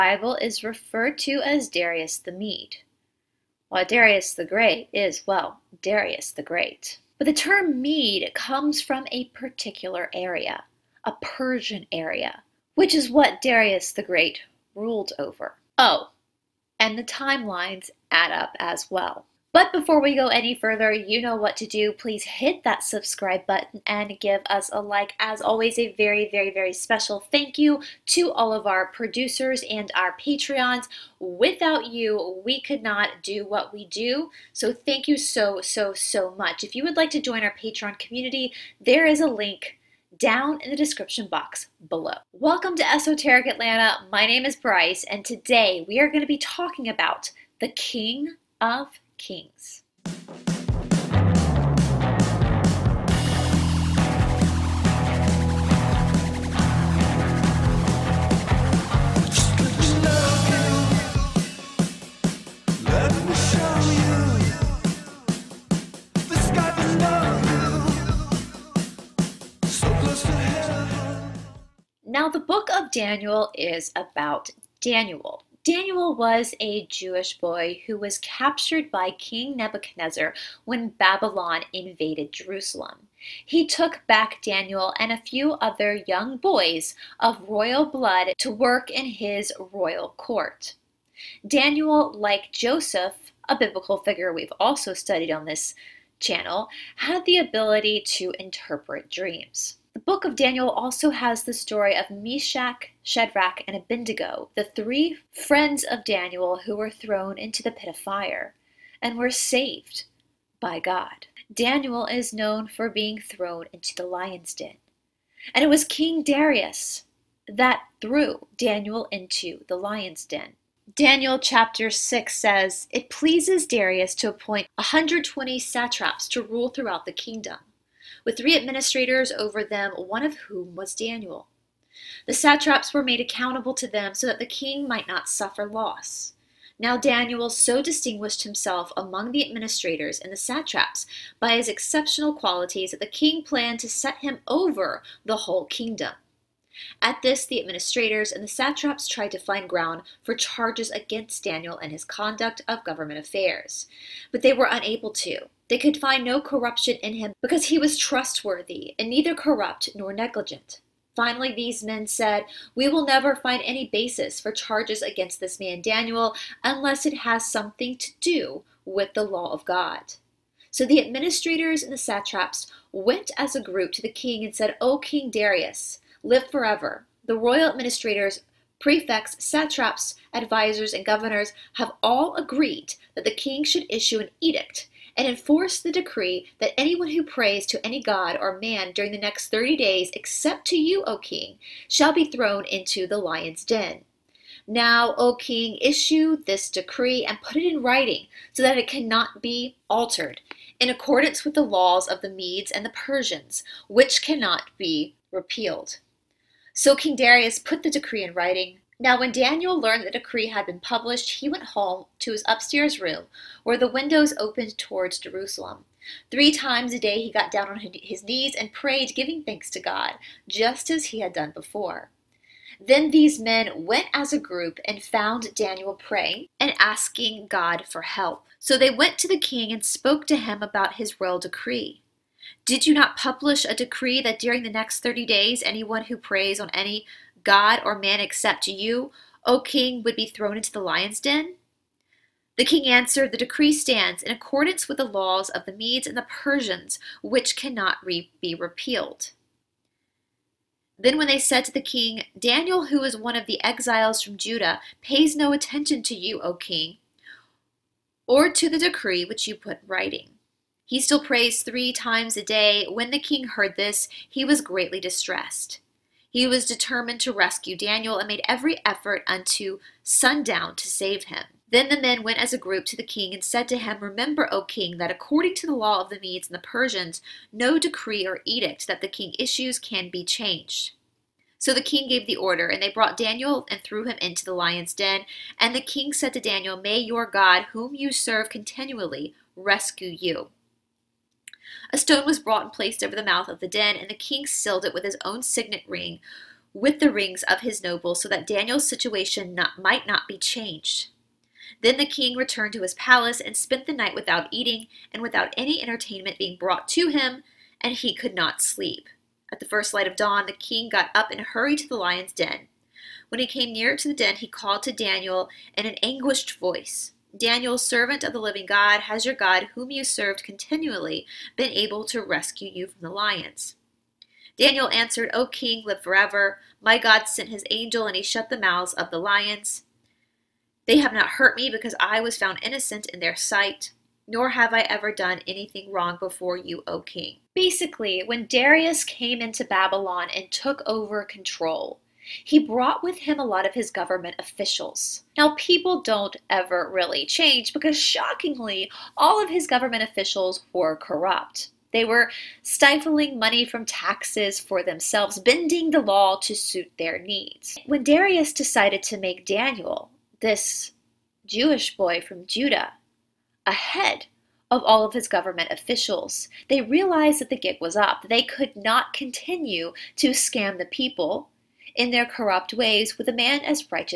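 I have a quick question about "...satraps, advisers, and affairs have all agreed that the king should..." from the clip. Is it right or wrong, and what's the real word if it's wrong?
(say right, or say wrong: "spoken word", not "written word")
wrong: "governors", not "affairs".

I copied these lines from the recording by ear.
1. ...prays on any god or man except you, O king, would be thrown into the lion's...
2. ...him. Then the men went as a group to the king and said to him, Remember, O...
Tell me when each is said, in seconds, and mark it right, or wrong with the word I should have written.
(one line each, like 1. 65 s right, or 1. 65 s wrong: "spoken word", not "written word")
1. 236 s right
2. 271 s right.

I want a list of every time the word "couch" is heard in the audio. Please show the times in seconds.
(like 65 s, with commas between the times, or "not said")
not said.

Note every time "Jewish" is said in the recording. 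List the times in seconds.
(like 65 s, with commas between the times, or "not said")
76 s, 361 s.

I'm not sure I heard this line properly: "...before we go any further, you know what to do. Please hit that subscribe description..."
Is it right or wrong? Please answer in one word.
wrong.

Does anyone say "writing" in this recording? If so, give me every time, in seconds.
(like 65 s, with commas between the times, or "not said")
197 s, 208 s, 259 s.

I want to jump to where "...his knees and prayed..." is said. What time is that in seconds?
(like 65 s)
217 s.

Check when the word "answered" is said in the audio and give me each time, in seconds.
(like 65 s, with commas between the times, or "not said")
242 s, 324 s.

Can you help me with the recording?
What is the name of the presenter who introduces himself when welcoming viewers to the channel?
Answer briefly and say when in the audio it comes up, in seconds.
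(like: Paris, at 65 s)
Brice, at 44 s.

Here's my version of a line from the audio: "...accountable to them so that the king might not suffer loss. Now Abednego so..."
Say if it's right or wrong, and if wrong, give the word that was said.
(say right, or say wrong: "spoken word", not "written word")
wrong: "Daniel", not "Abednego".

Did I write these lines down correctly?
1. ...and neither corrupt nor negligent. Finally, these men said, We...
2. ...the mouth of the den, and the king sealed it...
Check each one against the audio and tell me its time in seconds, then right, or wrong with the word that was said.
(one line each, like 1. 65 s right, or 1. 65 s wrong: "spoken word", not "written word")
1. 158 s right
2. 293 s right.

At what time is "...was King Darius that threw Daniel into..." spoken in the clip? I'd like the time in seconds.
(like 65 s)
115 s.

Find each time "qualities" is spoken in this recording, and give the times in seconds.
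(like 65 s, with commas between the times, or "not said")
142 s.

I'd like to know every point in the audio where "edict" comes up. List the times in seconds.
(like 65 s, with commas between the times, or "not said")
184 s, 278 s.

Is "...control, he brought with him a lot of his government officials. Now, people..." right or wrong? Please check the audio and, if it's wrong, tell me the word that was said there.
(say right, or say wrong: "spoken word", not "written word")
right.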